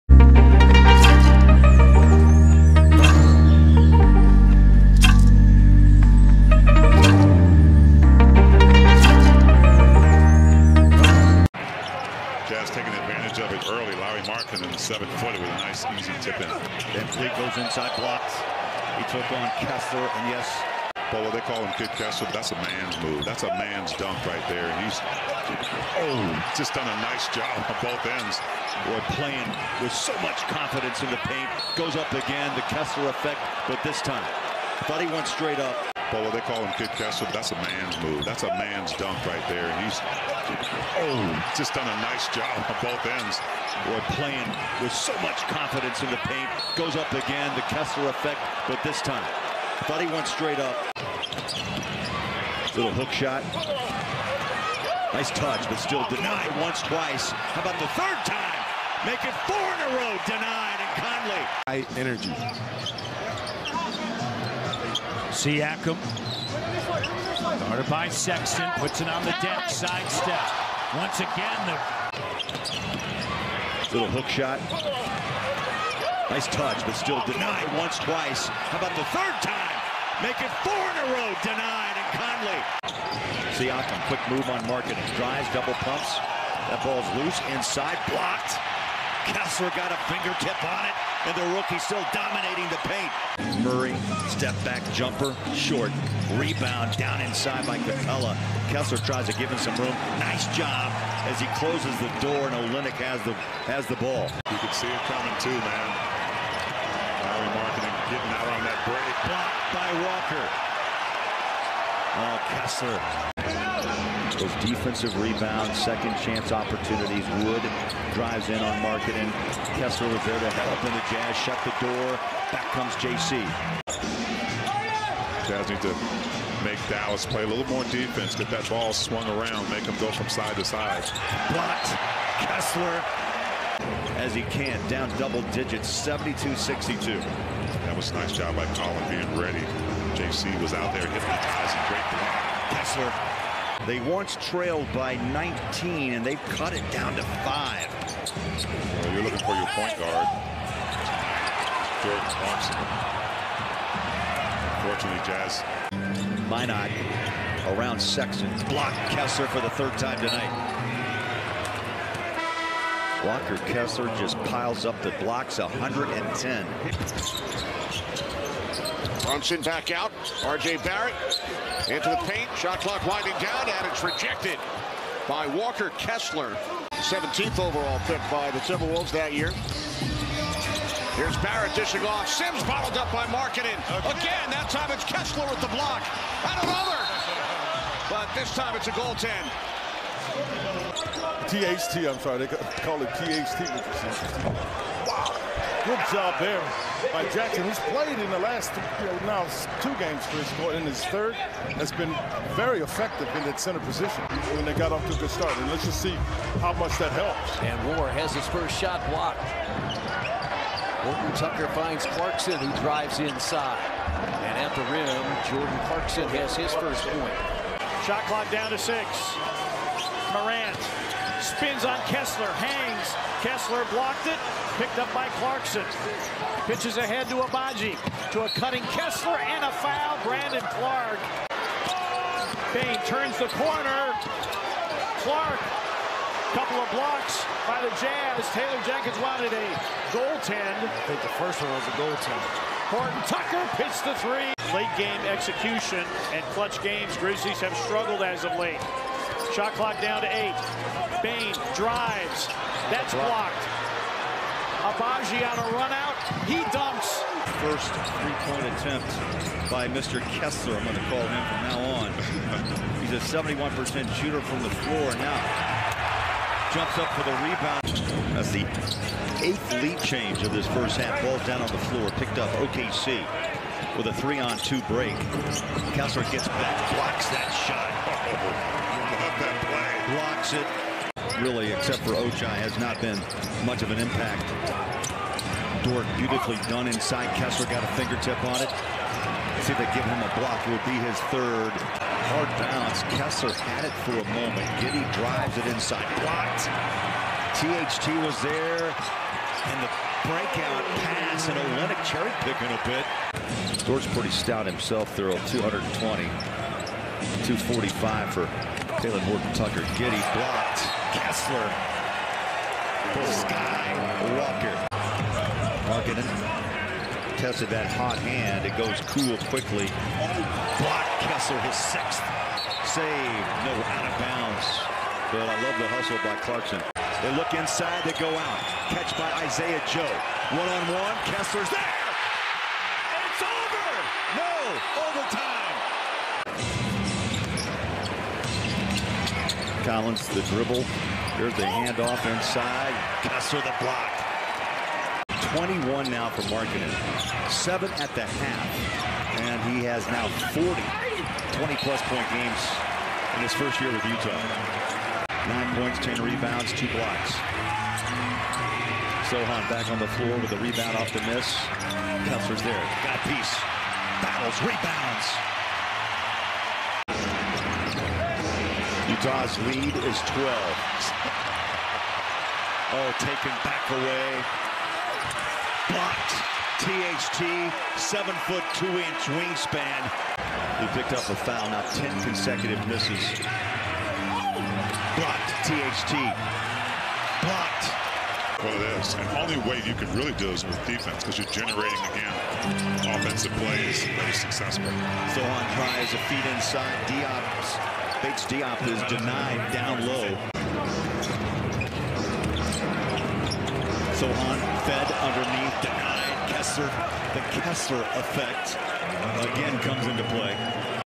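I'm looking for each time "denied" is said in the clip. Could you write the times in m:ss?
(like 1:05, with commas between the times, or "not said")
0:56, 1:00, 1:17, 1:21, 6:39, 6:45.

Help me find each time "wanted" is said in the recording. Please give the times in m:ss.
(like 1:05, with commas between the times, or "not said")
3:59.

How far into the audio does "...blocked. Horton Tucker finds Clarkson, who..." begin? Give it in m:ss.
3:29.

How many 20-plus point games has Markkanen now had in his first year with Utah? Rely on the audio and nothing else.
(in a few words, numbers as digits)
40.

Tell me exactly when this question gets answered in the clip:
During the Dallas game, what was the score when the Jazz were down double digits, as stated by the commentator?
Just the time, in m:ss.
2:16.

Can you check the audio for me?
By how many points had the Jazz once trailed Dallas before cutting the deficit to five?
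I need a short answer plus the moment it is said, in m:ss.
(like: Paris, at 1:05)
19, at 2:25.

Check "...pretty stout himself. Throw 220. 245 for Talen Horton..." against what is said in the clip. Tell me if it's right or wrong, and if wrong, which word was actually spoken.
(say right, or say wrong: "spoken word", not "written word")
right.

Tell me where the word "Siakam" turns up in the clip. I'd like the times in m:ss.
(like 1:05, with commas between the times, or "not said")
1:05, 1:23.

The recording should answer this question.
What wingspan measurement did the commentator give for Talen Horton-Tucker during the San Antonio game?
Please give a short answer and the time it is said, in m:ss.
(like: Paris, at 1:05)
7 foot 2 inch, at 6:17.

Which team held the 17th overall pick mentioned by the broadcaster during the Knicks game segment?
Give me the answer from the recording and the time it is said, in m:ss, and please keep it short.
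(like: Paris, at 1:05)
Timberwolves, at 2:58.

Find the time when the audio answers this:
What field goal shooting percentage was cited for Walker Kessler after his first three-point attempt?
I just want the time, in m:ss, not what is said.
4:23.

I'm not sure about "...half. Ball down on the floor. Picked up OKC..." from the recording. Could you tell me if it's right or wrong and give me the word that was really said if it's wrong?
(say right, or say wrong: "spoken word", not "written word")
right.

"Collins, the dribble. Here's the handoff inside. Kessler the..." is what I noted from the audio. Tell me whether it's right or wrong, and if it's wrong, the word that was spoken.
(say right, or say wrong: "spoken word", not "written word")
right.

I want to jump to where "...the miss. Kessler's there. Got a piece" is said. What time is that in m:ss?
6:01.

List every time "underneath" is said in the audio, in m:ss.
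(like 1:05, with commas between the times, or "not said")
6:45.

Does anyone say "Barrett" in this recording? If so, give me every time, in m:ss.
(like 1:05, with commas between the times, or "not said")
2:50, 3:01.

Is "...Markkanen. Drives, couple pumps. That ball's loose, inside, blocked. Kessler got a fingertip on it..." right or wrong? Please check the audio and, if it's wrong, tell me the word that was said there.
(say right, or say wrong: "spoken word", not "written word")
wrong: "double", not "couple".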